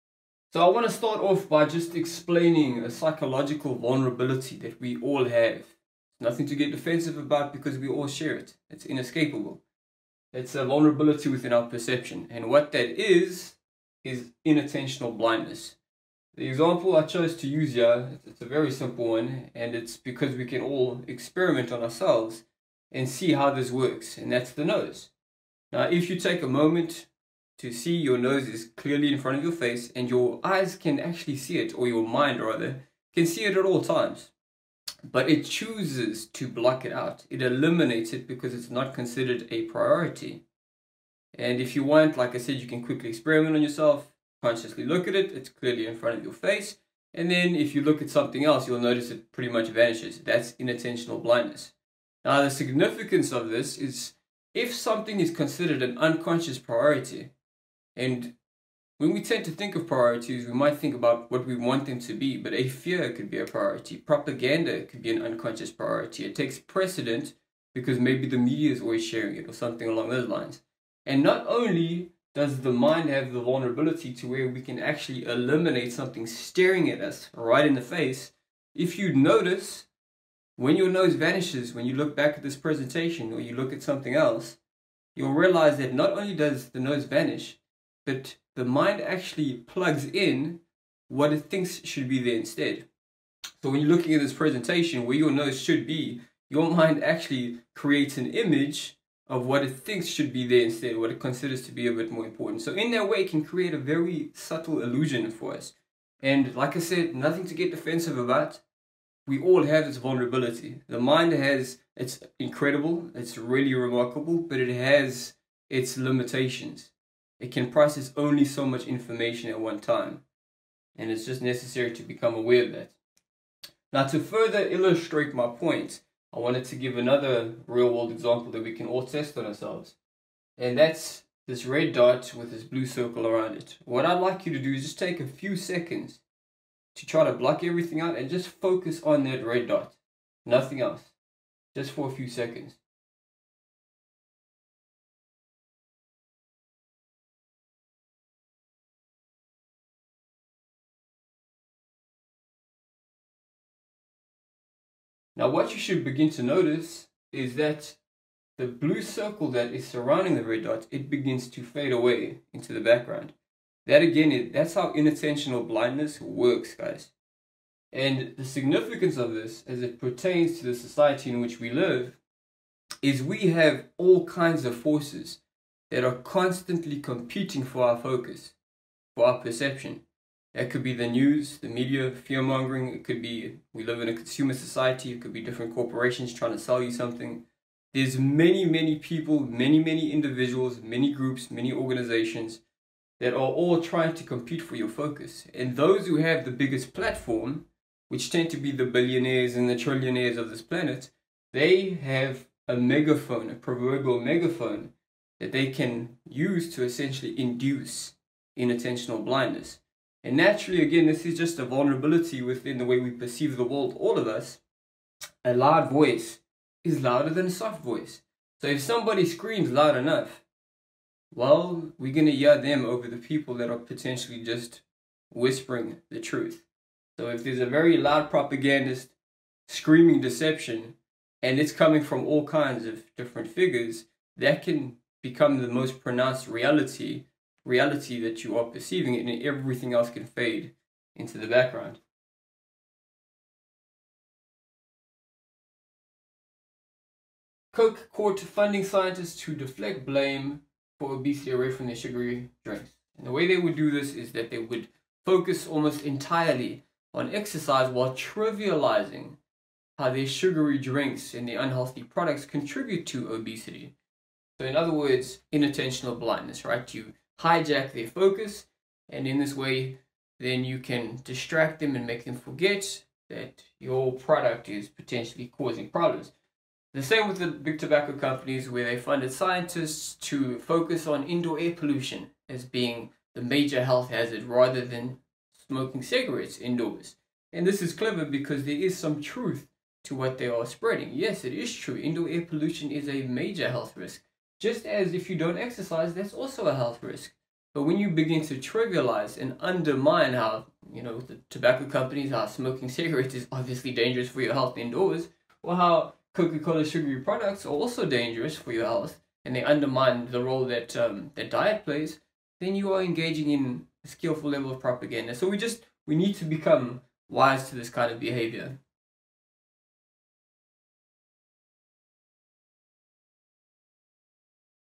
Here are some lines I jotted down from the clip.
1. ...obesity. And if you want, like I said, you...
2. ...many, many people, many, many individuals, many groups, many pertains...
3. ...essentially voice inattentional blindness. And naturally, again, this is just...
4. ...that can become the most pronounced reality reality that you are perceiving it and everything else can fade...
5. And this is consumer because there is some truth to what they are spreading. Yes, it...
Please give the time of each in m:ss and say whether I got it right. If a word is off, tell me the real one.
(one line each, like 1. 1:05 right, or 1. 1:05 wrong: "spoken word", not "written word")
1. 0:39 wrong: "priority", not "obesity"
2. 3:08 wrong: "organizations", not "pertains"
3. 3:26 wrong: "induce", not "voice"
4. 3:54 right
5. 4:47 wrong: "clever", not "consumer".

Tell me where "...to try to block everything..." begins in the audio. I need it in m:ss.
2:16.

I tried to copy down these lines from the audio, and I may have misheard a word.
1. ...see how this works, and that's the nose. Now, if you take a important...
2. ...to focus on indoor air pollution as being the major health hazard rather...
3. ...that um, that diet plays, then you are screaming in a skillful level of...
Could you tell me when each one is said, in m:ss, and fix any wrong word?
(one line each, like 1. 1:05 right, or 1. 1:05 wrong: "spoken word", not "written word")
1. 0:23 wrong: "moment", not "important"
2. 4:40 right
3. 5:10 wrong: "engaging", not "screaming".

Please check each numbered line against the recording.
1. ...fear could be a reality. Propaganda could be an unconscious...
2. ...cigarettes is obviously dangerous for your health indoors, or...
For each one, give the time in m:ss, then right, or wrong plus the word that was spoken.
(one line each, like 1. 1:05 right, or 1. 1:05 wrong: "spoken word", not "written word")
1. 1:02 wrong: "priority", not "reality"
2. 5:02 right.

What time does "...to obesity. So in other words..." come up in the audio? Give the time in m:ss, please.
4:23.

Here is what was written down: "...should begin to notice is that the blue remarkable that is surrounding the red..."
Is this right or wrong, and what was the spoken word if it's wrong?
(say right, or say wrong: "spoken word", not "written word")
wrong: "circle", not "remarkable".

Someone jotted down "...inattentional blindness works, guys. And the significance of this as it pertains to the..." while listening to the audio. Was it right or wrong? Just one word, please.
right.